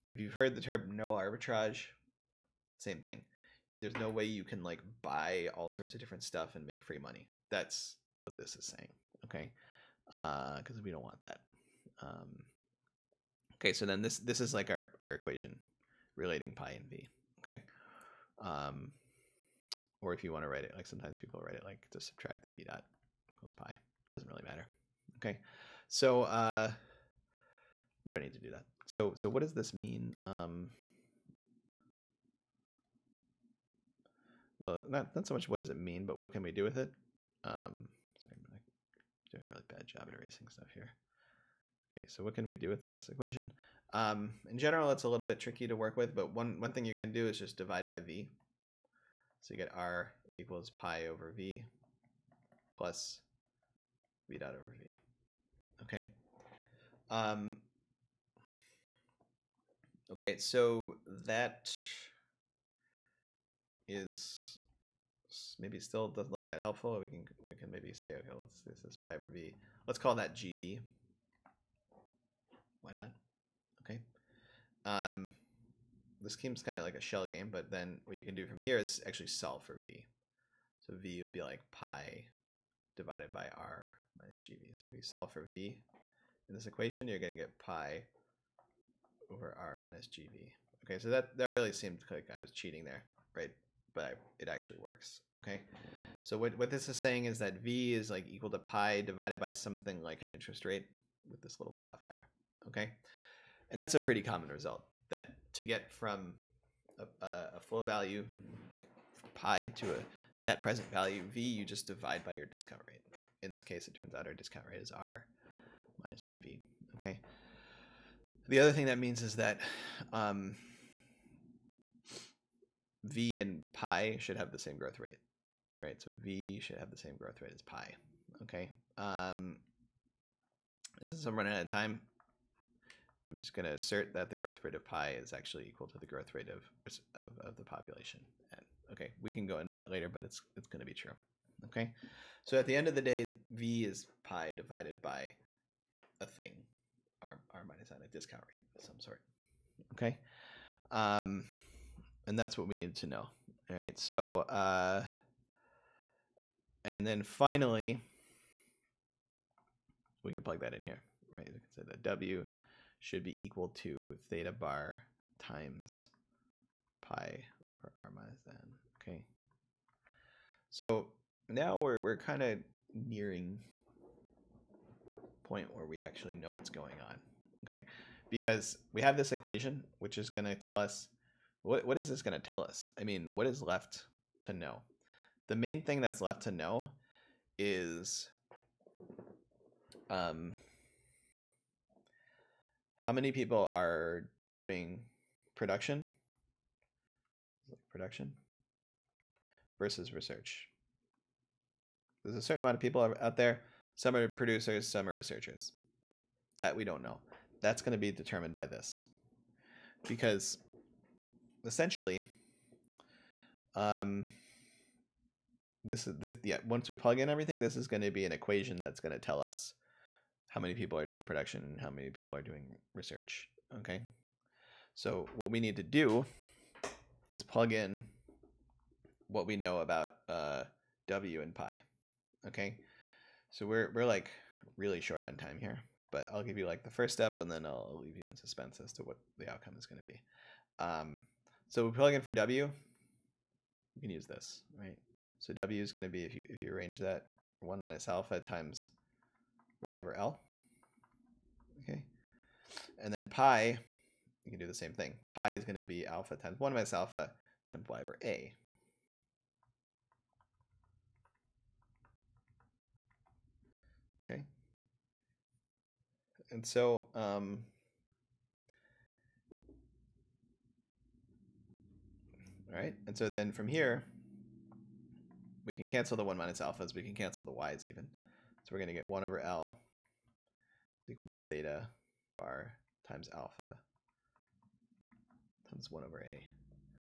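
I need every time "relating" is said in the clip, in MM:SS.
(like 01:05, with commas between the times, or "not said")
00:16.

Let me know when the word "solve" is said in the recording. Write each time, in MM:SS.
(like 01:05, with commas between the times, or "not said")
01:19, 01:25.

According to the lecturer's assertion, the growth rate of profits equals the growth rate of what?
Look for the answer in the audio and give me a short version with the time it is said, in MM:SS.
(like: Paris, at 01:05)
the population, at 02:17.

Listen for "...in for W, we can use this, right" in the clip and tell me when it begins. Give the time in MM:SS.
04:02.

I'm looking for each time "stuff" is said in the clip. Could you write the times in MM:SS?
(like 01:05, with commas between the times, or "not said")
00:06, 00:40.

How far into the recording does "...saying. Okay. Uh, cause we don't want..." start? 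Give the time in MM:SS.
00:08.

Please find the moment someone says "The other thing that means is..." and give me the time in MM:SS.
01:58.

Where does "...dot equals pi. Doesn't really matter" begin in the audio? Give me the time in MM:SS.
00:22.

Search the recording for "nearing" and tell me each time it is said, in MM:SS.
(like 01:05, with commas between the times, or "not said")
02:53.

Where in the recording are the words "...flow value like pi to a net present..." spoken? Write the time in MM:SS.
01:47.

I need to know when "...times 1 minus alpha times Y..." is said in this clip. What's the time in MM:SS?
04:16.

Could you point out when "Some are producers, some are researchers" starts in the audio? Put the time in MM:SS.
03:23.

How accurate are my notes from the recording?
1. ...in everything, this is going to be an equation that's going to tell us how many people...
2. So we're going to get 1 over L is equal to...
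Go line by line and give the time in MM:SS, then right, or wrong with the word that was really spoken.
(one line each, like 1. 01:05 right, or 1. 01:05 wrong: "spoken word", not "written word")
1. 03:37 right
2. 04:38 right.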